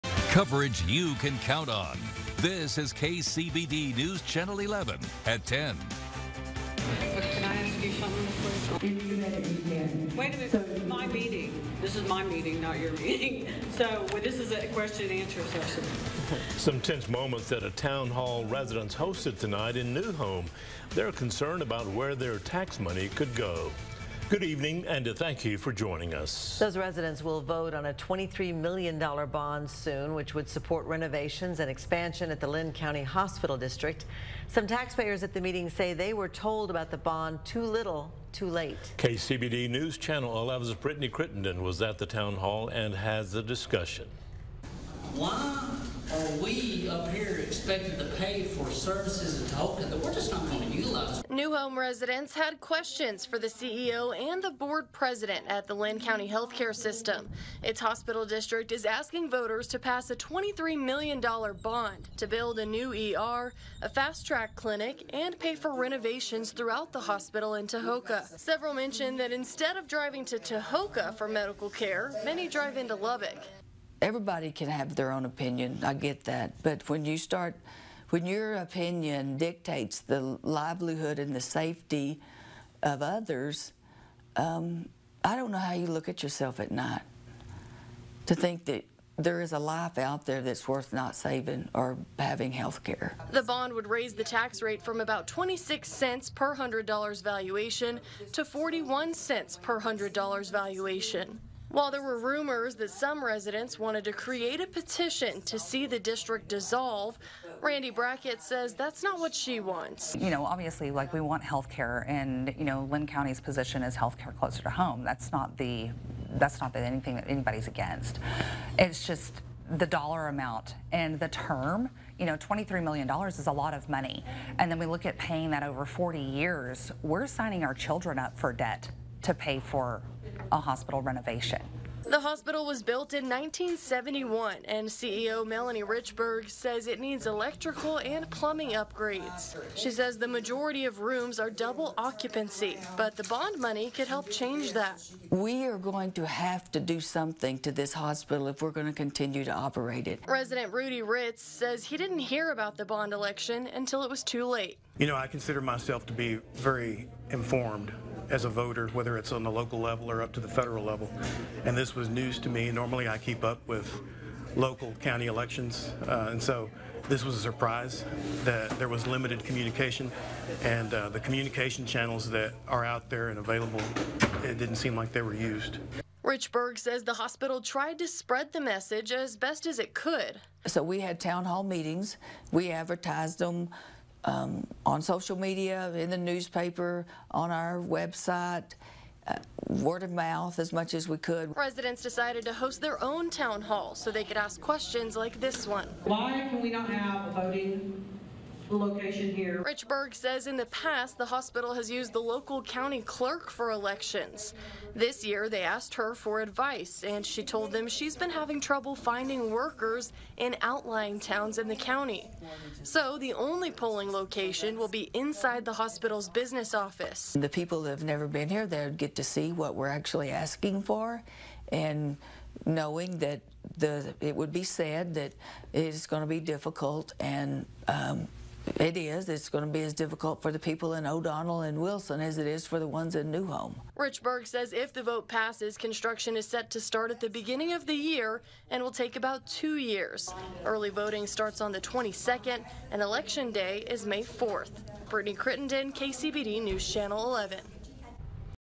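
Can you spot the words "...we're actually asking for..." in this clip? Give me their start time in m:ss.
3:39.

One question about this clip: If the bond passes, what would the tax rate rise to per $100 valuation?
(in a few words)
41 cents.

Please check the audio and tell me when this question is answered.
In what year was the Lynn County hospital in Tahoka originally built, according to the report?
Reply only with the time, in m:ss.
2:13.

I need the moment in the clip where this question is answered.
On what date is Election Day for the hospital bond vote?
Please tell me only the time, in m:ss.
4:04.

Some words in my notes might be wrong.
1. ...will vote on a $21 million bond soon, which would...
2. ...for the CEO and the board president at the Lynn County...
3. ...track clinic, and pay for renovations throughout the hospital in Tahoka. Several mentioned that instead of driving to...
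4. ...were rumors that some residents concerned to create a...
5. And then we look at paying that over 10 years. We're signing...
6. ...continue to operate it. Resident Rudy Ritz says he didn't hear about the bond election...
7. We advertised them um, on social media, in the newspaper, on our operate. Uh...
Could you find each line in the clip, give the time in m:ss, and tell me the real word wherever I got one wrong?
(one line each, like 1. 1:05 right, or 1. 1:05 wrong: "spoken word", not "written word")
1. 0:27 wrong: "23", not "21"
2. 0:53 right
3. 1:04 right
4. 1:42 wrong: "wanted", not "concerned"
5. 2:04 wrong: "40", not "10"
6. 2:28 right
7. 3:02 wrong: "website", not "operate".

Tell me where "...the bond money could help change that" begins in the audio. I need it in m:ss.
2:23.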